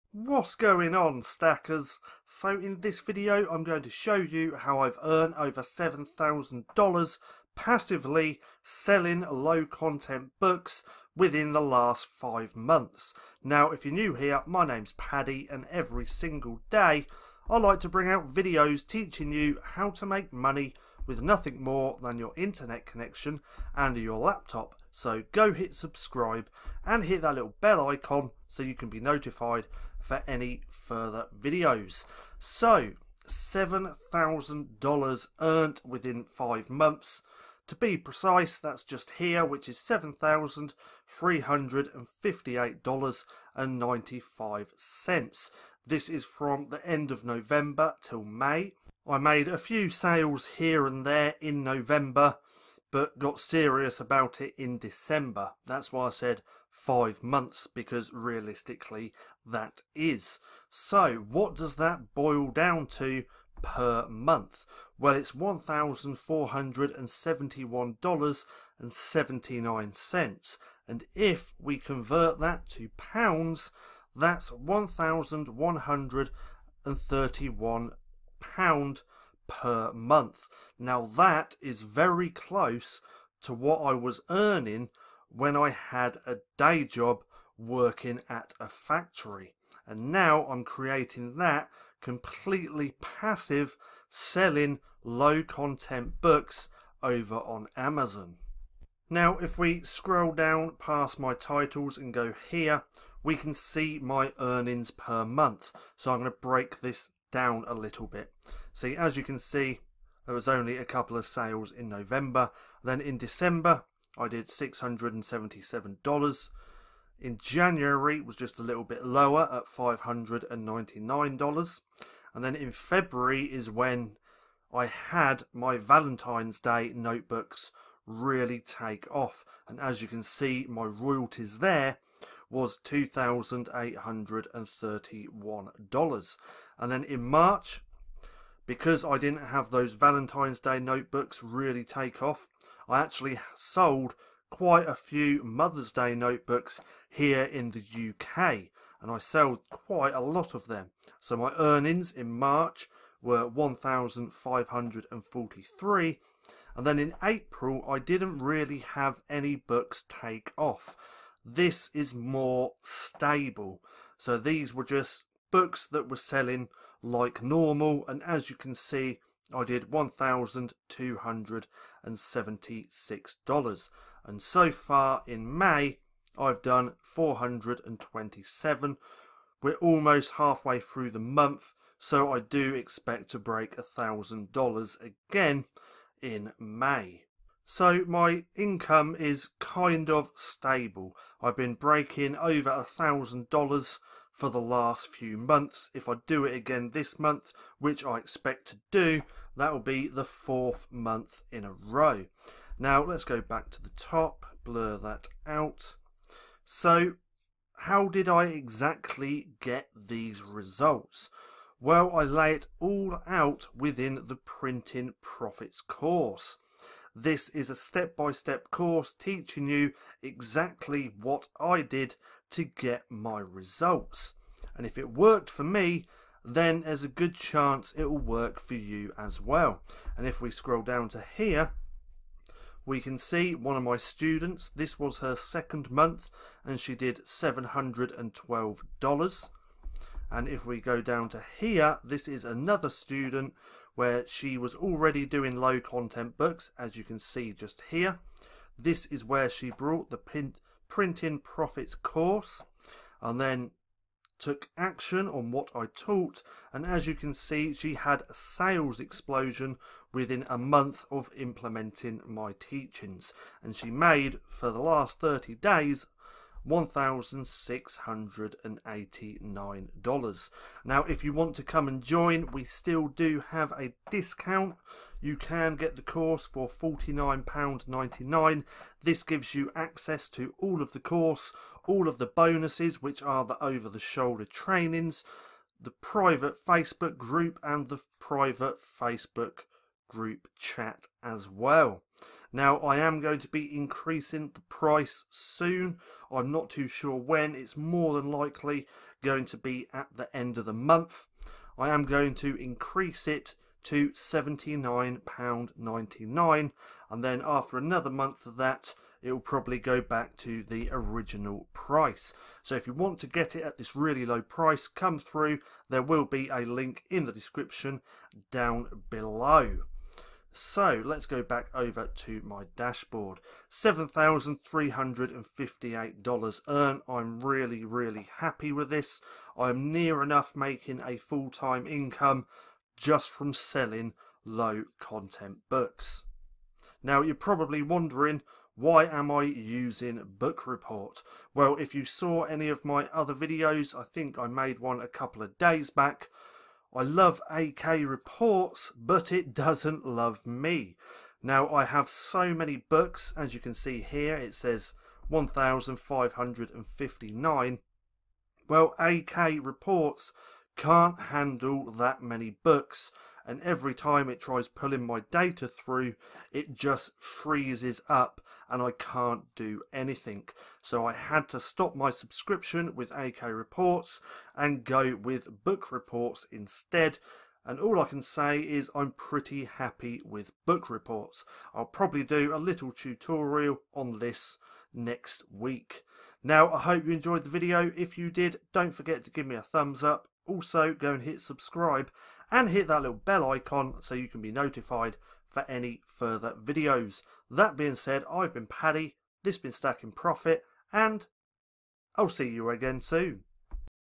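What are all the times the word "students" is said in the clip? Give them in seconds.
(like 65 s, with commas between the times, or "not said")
233 s, 242 s.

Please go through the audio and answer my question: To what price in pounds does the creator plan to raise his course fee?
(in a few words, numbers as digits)
£79.99.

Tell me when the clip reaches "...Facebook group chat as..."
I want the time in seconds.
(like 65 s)
288 s.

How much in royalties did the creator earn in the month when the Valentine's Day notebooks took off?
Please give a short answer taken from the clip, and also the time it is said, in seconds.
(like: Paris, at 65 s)
$2,831, at 132 s.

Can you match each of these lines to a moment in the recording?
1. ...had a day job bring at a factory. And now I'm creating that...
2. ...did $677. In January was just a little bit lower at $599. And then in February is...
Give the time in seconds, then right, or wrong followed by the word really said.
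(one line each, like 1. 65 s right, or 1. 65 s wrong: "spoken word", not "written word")
1. 85 s wrong: "working", not "bring"
2. 114 s right.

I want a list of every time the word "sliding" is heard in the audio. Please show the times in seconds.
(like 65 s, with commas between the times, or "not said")
not said.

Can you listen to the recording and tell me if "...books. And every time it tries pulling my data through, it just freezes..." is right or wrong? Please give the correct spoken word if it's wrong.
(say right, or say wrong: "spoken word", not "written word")
right.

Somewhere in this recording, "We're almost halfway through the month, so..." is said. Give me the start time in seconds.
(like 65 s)
179 s.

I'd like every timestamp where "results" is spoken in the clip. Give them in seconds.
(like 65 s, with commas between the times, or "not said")
210 s, 223 s.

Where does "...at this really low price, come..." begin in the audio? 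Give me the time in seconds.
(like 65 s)
313 s.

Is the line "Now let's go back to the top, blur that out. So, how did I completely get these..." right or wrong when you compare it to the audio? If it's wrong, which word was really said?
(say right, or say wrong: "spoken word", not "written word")
wrong: "exactly", not "completely".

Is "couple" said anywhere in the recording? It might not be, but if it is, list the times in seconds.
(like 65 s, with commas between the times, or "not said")
110 s, 345 s.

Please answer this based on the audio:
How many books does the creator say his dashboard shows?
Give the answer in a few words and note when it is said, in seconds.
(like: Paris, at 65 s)
1,559, at 355 s.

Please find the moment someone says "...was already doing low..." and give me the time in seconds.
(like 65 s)
244 s.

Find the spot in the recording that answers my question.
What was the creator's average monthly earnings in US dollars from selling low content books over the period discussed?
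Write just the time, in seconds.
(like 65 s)
65 s.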